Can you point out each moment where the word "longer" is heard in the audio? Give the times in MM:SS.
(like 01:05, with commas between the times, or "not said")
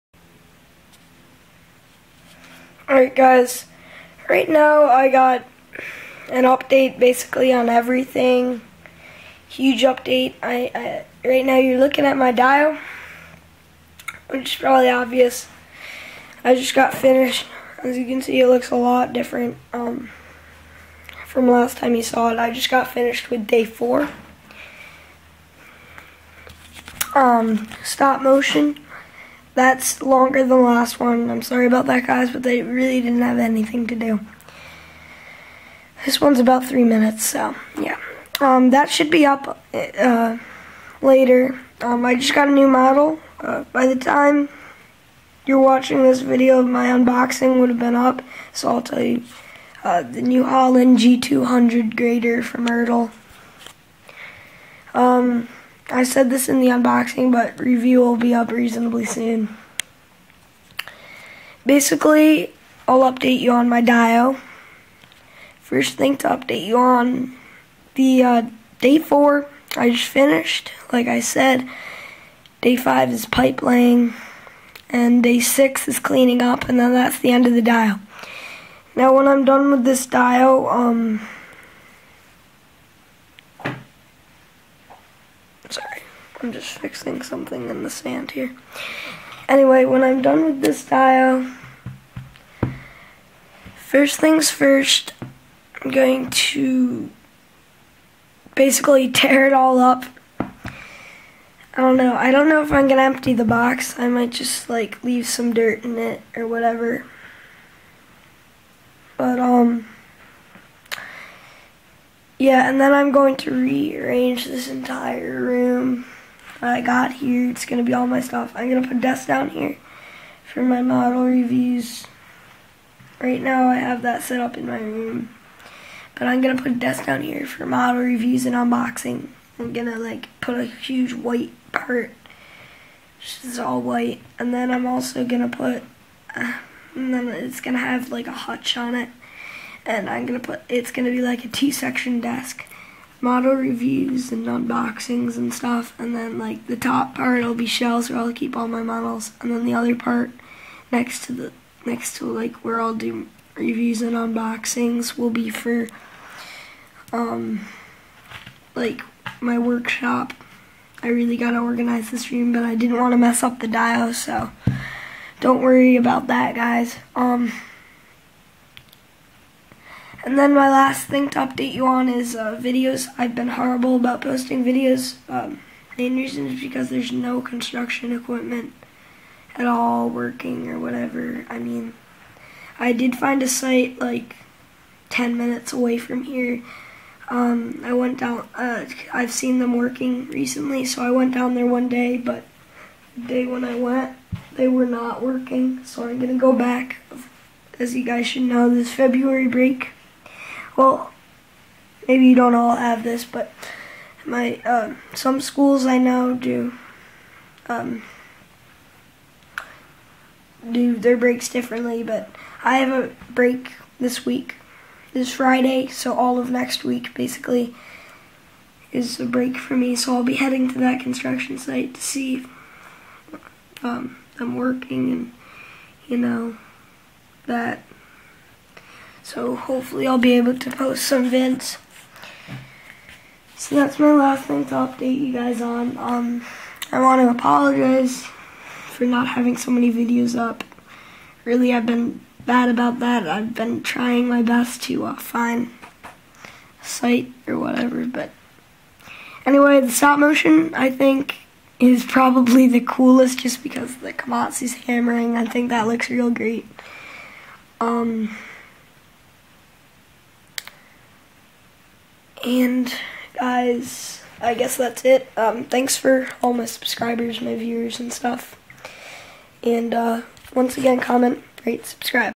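00:30.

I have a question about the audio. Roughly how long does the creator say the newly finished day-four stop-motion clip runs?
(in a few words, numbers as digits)
3 minutes.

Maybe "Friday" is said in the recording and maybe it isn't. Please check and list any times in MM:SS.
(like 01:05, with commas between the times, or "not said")
03:35.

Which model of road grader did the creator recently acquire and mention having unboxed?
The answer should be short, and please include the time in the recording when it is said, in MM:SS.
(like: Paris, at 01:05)
New Holland G200, at 00:50.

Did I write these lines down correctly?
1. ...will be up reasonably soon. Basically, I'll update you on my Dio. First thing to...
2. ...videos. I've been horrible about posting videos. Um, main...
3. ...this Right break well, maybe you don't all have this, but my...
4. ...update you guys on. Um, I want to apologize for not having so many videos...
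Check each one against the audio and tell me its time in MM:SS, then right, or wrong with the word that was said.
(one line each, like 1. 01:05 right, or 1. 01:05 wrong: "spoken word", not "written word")
1. 00:57 right
2. 02:52 right
3. 03:18 wrong: "February", not "Right"
4. 03:54 right.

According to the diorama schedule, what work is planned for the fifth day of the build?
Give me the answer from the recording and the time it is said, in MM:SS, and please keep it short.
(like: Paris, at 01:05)
Pipe laying, at 01:13.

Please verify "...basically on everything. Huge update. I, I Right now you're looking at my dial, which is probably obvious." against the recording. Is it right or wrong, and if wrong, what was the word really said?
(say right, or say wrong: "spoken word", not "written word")
right.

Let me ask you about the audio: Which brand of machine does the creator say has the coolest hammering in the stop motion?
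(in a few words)
Komatsu.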